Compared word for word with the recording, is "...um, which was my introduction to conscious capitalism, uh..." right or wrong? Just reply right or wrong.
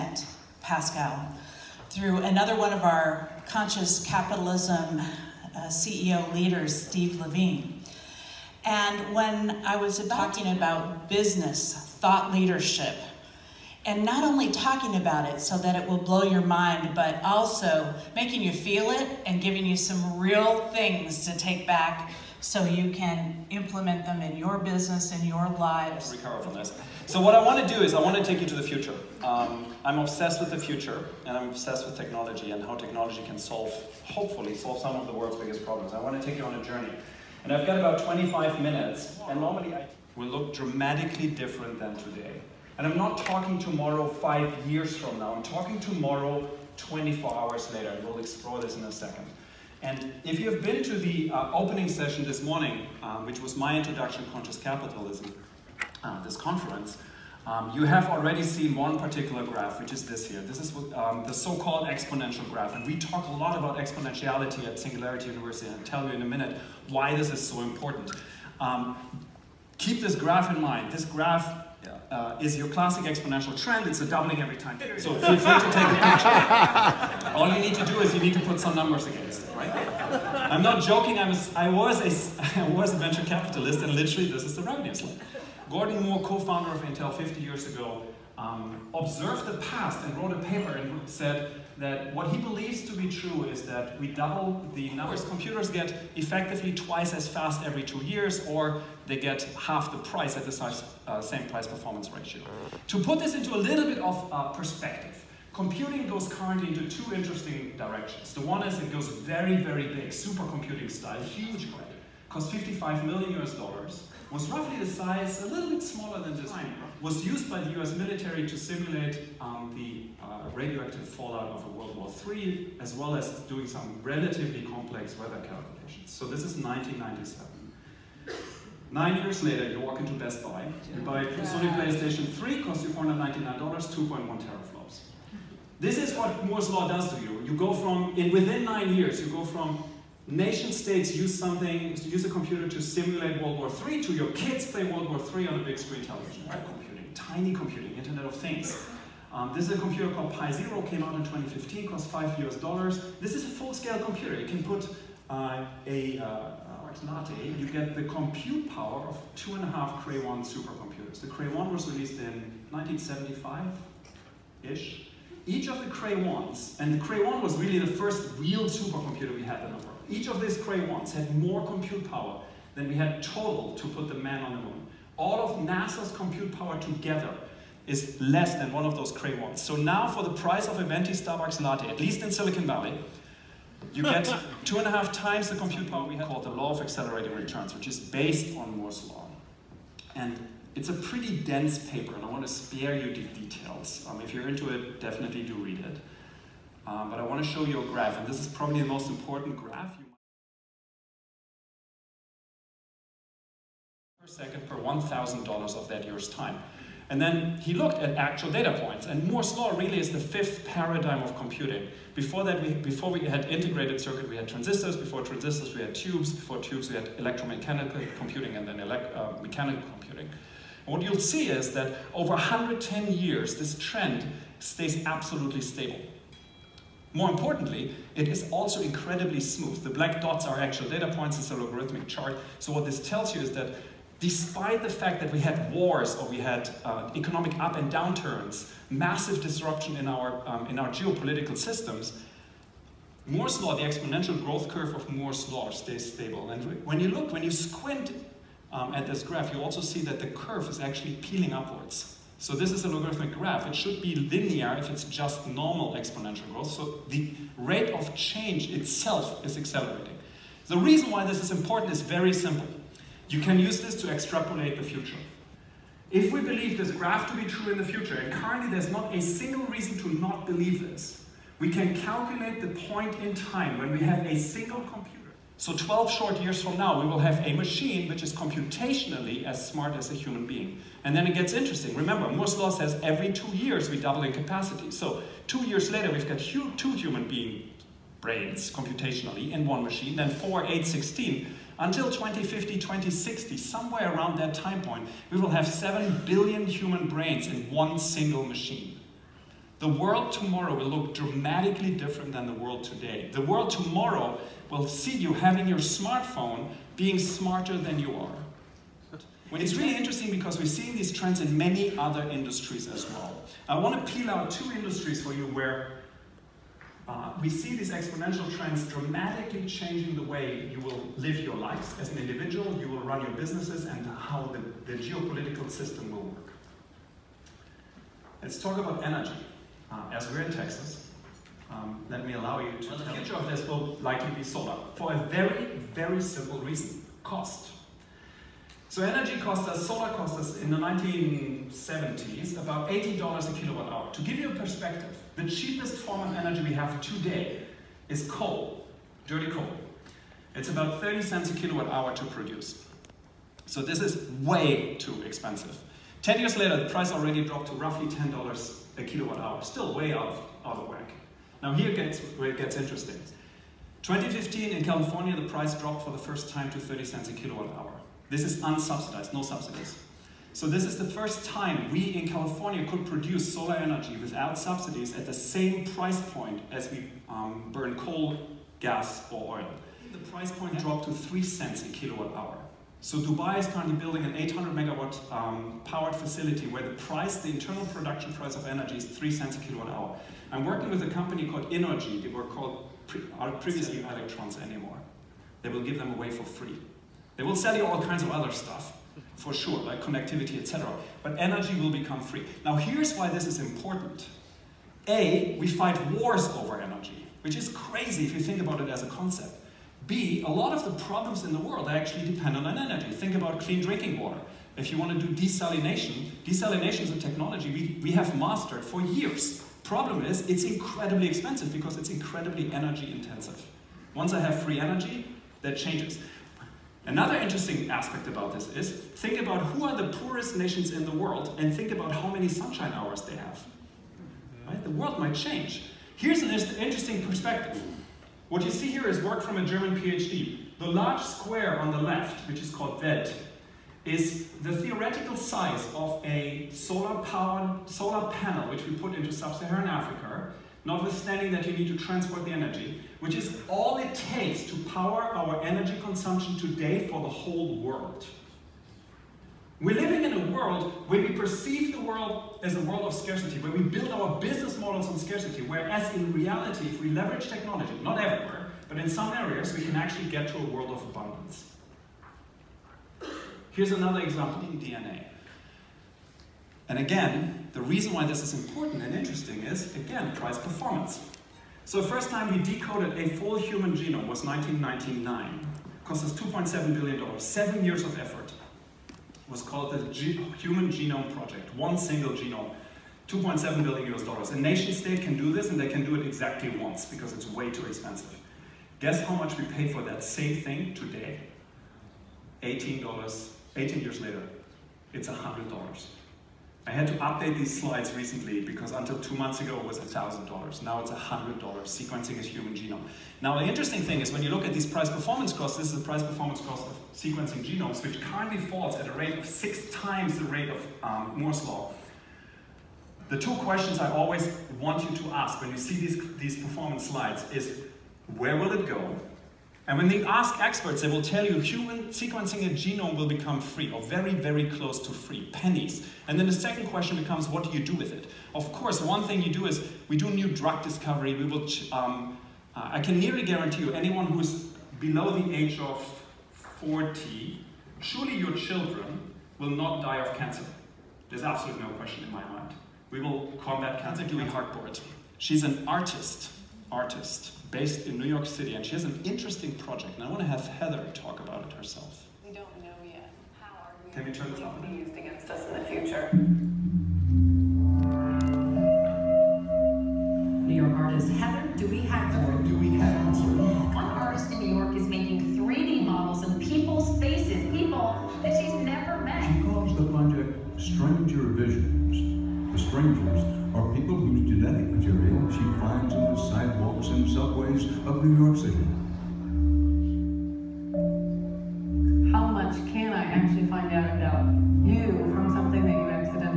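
right.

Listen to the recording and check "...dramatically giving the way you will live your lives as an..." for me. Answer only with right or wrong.
wrong.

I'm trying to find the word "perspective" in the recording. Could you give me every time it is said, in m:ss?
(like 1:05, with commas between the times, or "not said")
1:44, 5:44, 7:17.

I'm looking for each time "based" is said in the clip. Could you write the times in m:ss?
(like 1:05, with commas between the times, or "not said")
3:07, 9:17.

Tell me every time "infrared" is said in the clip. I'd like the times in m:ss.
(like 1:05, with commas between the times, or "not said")
not said.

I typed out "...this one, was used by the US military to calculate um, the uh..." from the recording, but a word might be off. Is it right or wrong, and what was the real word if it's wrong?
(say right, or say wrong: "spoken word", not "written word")
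wrong: "simulate", not "calculate".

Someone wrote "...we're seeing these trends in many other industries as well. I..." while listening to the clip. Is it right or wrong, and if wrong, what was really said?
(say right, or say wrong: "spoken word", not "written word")
right.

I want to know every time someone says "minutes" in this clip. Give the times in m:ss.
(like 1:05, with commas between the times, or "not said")
0:38, 1:06.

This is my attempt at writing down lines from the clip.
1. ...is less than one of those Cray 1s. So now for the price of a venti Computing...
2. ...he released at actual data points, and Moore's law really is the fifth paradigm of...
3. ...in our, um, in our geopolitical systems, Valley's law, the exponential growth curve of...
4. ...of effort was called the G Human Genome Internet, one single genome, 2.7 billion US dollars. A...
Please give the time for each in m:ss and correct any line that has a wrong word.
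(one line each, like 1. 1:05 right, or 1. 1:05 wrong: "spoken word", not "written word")
1. 2:57 wrong: "Starbucks", not "Computing"
2. 3:27 wrong: "looked", not "released"
3. 3:59 wrong: "Moore", not "Valley"
4. 8:08 wrong: "Project", not "Internet".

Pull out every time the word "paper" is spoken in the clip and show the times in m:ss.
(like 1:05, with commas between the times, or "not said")
1:30, 3:11.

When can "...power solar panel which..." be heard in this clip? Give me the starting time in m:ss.
7:27.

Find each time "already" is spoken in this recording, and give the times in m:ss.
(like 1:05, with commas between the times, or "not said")
0:58, 5:57.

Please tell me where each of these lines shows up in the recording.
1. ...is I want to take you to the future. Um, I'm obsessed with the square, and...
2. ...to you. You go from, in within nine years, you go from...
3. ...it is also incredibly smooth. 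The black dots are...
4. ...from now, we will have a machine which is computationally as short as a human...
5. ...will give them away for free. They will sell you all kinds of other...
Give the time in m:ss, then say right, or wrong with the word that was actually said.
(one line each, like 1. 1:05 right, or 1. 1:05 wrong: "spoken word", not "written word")
1. 0:27 wrong: "future", not "square"
2. 2:17 right
3. 3:48 right
4. 4:36 wrong: "smart", not "short"
5. 6:35 right.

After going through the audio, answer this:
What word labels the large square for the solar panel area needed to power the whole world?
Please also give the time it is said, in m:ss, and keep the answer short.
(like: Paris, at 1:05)
Welt, at 7:23.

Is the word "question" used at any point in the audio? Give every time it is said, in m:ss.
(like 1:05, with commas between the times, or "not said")
8:43, 8:56, 9:11.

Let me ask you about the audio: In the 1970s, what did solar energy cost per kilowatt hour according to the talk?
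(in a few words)
$80.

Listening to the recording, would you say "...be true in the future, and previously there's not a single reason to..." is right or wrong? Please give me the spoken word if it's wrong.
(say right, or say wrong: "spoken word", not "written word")
wrong: "currently", not "previously".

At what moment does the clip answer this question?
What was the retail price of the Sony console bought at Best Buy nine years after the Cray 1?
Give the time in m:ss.
2:12.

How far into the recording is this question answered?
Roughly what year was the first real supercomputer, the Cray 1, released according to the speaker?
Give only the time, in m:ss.
2:42.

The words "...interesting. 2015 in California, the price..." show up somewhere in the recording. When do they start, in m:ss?
6:02.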